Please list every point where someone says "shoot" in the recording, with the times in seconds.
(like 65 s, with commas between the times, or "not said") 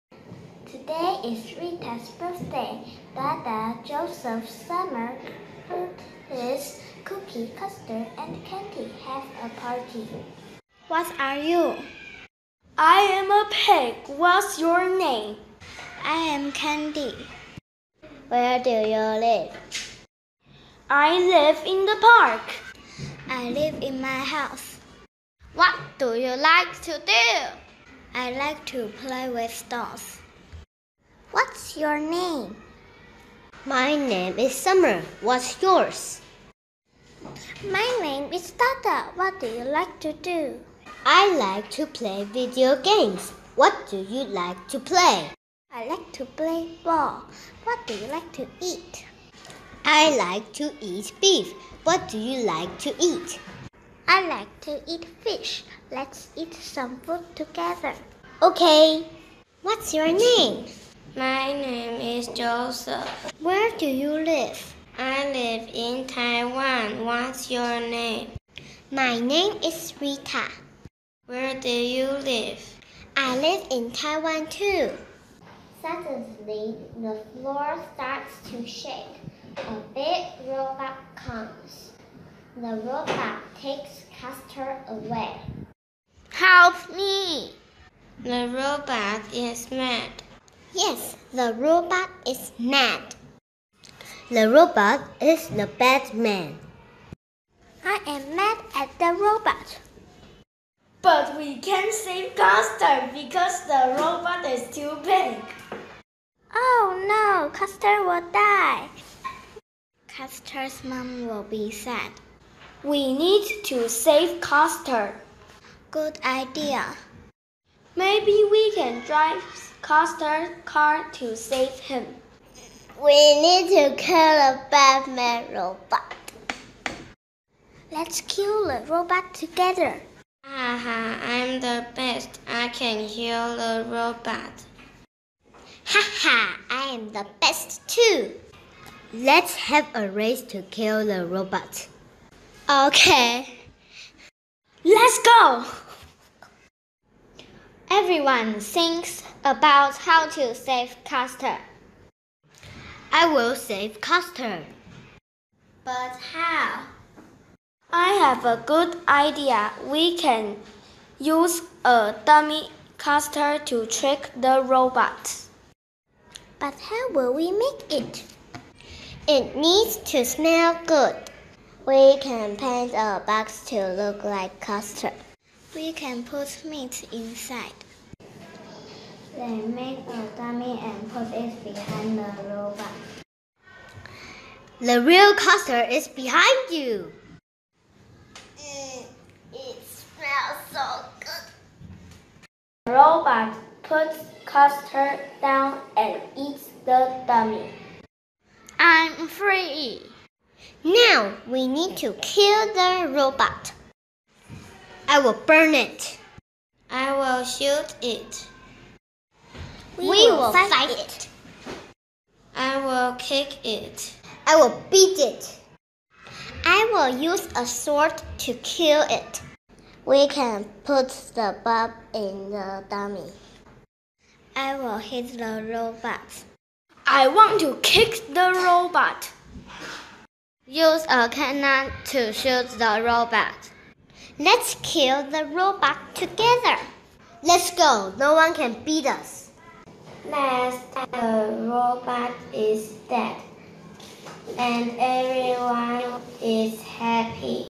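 207 s, 232 s.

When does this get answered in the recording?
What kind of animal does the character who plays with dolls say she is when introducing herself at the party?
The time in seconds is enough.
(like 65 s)
12 s.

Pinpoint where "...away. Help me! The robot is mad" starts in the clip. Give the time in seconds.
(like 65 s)
84 s.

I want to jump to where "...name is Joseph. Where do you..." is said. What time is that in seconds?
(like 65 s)
61 s.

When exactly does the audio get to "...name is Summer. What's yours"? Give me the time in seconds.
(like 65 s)
33 s.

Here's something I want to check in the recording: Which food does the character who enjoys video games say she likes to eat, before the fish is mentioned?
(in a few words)
beef.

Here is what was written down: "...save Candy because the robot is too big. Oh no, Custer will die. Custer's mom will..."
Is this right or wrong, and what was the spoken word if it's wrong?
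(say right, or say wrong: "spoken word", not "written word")
wrong: "Custer", not "Candy".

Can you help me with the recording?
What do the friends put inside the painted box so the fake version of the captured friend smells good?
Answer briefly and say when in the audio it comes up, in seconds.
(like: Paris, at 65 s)
meat, at 175 s.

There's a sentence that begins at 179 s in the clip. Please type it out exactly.
They make a dummy and put it behind the robot.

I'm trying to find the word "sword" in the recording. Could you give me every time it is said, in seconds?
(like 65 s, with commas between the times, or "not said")
217 s.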